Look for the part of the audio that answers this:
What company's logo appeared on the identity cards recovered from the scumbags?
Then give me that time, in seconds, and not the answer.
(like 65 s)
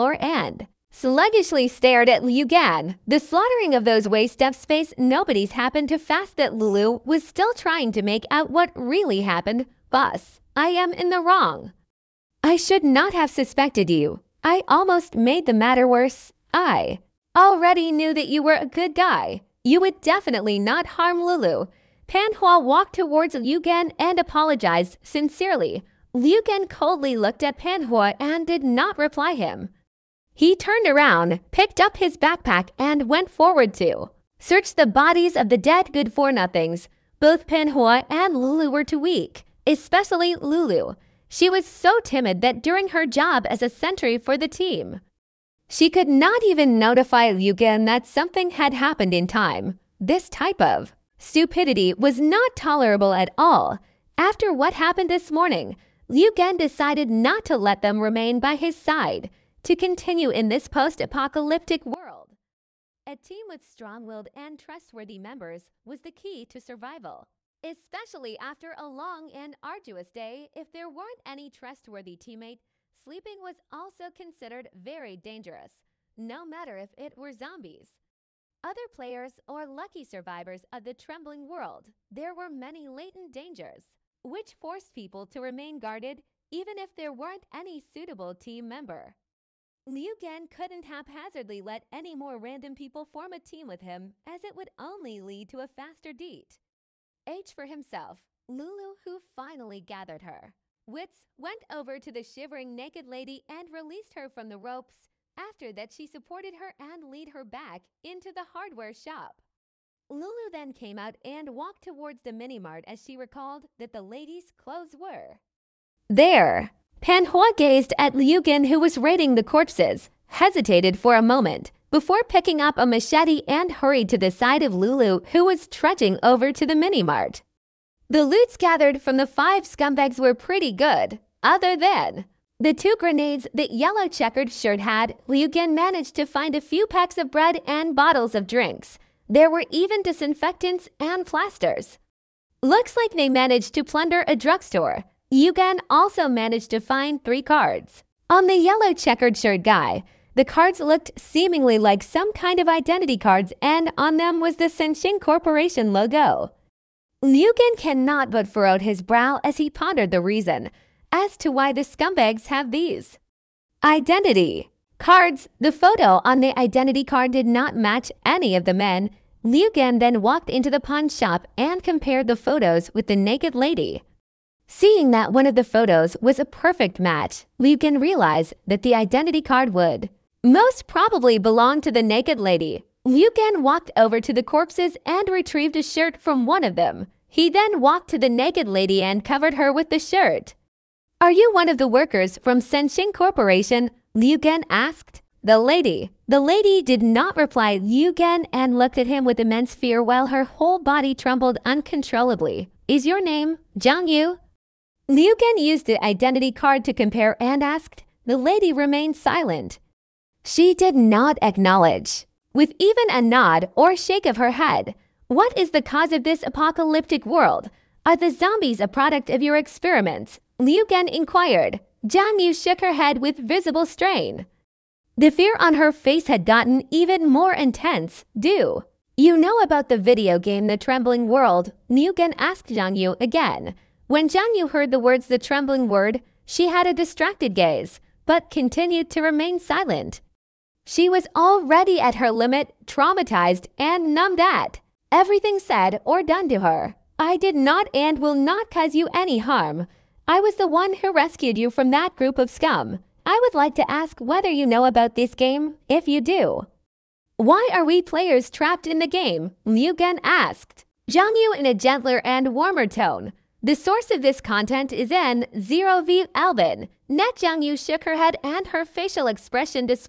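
154 s.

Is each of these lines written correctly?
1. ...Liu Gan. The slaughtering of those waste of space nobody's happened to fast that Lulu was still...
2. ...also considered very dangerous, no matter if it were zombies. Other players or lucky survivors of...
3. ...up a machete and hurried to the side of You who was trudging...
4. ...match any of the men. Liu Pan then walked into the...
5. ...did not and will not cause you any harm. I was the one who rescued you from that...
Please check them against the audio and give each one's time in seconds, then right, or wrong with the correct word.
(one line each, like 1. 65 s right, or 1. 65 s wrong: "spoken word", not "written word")
1. 2 s right
2. 73 s right
3. 122 s wrong: "Lulu", not "You"
4. 167 s wrong: "Gan", not "Pan"
5. 247 s right.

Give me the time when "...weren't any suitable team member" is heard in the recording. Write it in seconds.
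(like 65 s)
87 s.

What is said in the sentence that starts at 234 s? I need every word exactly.
When Jiang Yu heard the words The Trembling Word, she had a distracted gaze, but continued to remain silent.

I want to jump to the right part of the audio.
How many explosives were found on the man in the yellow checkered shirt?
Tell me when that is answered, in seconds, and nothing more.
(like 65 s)
132 s.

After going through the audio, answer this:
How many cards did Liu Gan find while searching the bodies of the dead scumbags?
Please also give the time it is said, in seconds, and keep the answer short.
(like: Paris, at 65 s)
3, at 147 s.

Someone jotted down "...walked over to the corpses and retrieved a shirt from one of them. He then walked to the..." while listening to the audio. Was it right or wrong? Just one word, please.
right.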